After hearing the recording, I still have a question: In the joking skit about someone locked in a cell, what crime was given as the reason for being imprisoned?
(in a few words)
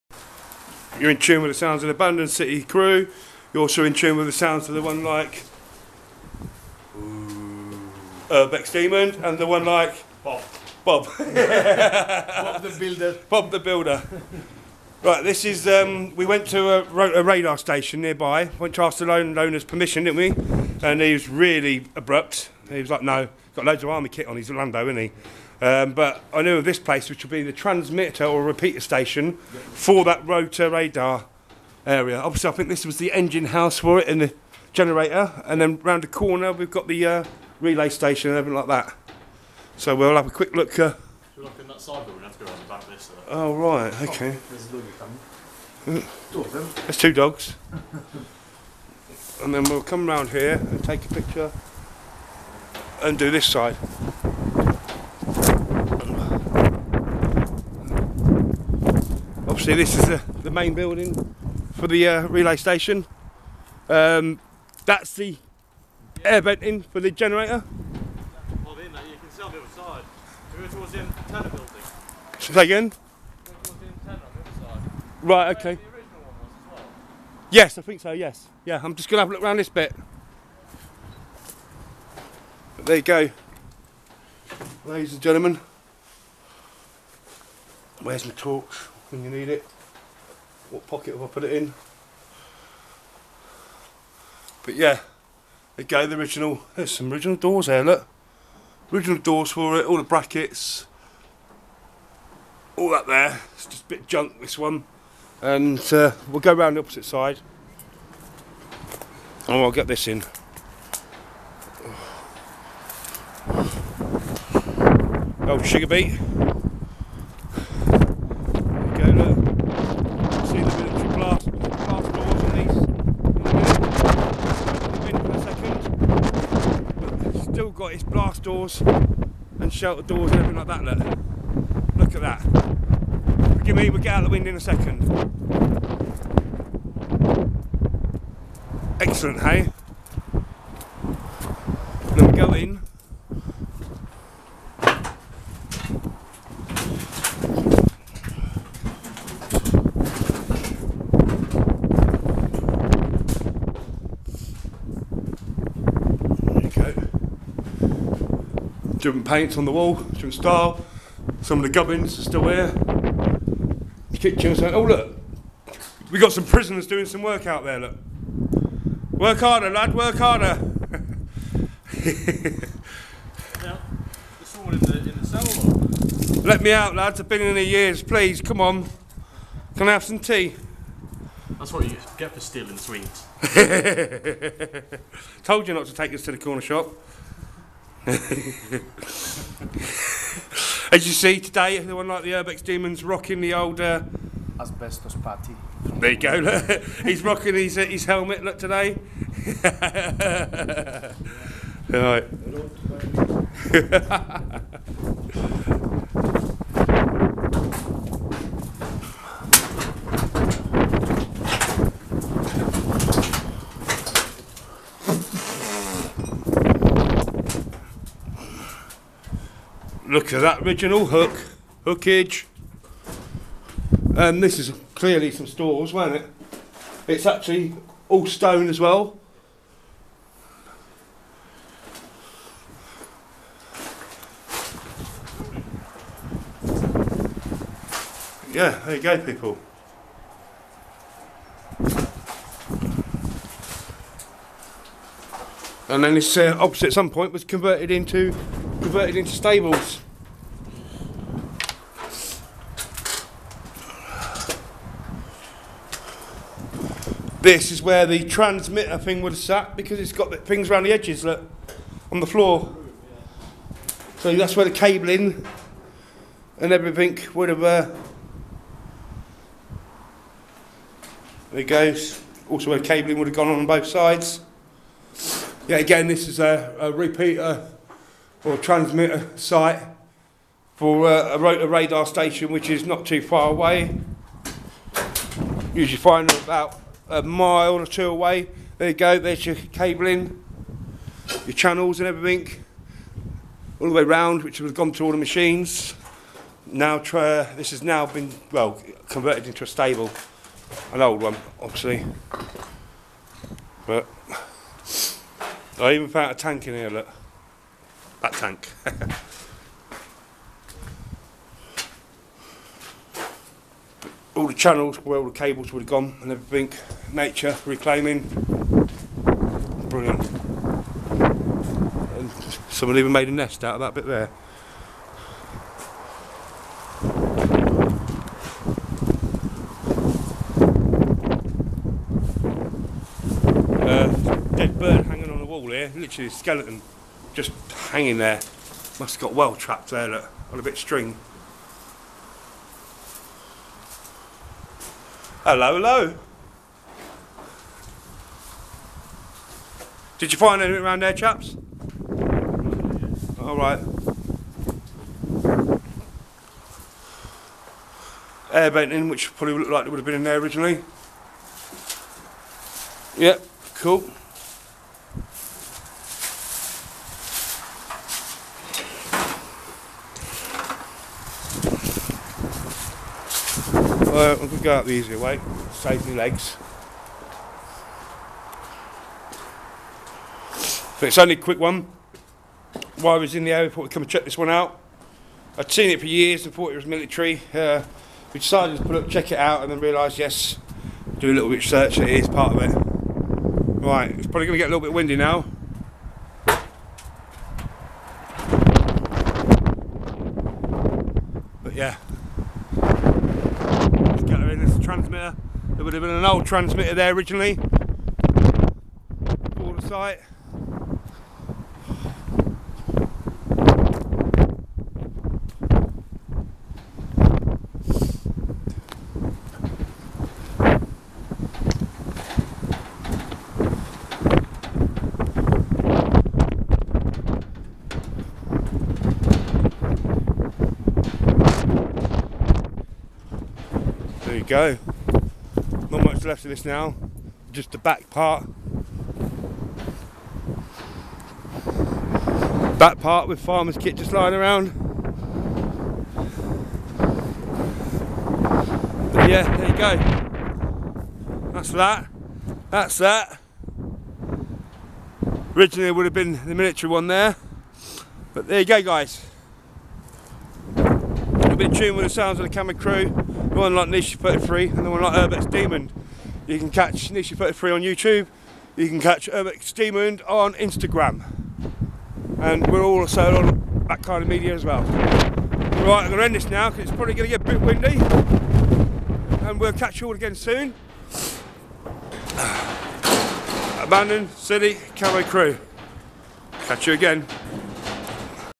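Stealing sweets.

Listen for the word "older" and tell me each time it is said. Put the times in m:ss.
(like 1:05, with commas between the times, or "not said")
3:13.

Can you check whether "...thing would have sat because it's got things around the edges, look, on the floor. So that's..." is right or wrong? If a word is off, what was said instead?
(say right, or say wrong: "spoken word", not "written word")
right.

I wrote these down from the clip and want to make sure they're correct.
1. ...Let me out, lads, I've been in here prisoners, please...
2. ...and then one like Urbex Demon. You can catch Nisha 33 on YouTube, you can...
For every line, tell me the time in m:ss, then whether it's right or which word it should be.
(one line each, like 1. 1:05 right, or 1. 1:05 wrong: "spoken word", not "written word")
1. 2:56 wrong: "years", not "prisoners"
2. 7:44 right.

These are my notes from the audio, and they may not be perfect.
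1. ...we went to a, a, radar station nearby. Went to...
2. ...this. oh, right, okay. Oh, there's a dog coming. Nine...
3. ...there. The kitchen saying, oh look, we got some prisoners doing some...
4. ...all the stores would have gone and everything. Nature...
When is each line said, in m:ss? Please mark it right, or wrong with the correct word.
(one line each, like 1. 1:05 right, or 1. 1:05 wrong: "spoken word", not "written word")
1. 0:16 right
2. 0:42 wrong: "Two", not "Nine"
3. 2:42 right
4. 5:15 wrong: "cables", not "stores".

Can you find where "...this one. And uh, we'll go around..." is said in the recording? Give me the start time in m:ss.
1:44.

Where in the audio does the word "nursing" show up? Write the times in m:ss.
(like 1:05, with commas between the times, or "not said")
not said.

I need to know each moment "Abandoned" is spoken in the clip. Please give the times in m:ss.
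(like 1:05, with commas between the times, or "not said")
0:01, 8:03.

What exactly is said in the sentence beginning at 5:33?
Uh, dead bird hanging on the wall here, literally a skeleton just hanging there.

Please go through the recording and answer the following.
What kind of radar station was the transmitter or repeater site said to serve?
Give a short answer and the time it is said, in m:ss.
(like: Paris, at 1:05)
Rotor, at 0:30.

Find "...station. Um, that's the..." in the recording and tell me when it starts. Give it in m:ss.
1:02.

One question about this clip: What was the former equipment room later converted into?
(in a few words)
Stables.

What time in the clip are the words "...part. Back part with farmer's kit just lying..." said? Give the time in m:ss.
7:18.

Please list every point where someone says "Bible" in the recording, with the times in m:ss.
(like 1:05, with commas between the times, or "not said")
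not said.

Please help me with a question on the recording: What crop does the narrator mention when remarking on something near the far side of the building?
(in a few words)
Sugar beet.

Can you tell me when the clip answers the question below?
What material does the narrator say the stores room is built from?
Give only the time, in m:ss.
3:48.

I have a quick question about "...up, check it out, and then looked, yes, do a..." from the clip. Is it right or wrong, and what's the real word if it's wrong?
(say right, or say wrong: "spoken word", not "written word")
wrong: "realised", not "looked".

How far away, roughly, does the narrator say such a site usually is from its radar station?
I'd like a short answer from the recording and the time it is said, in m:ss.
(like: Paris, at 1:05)
A mile or two, at 4:47.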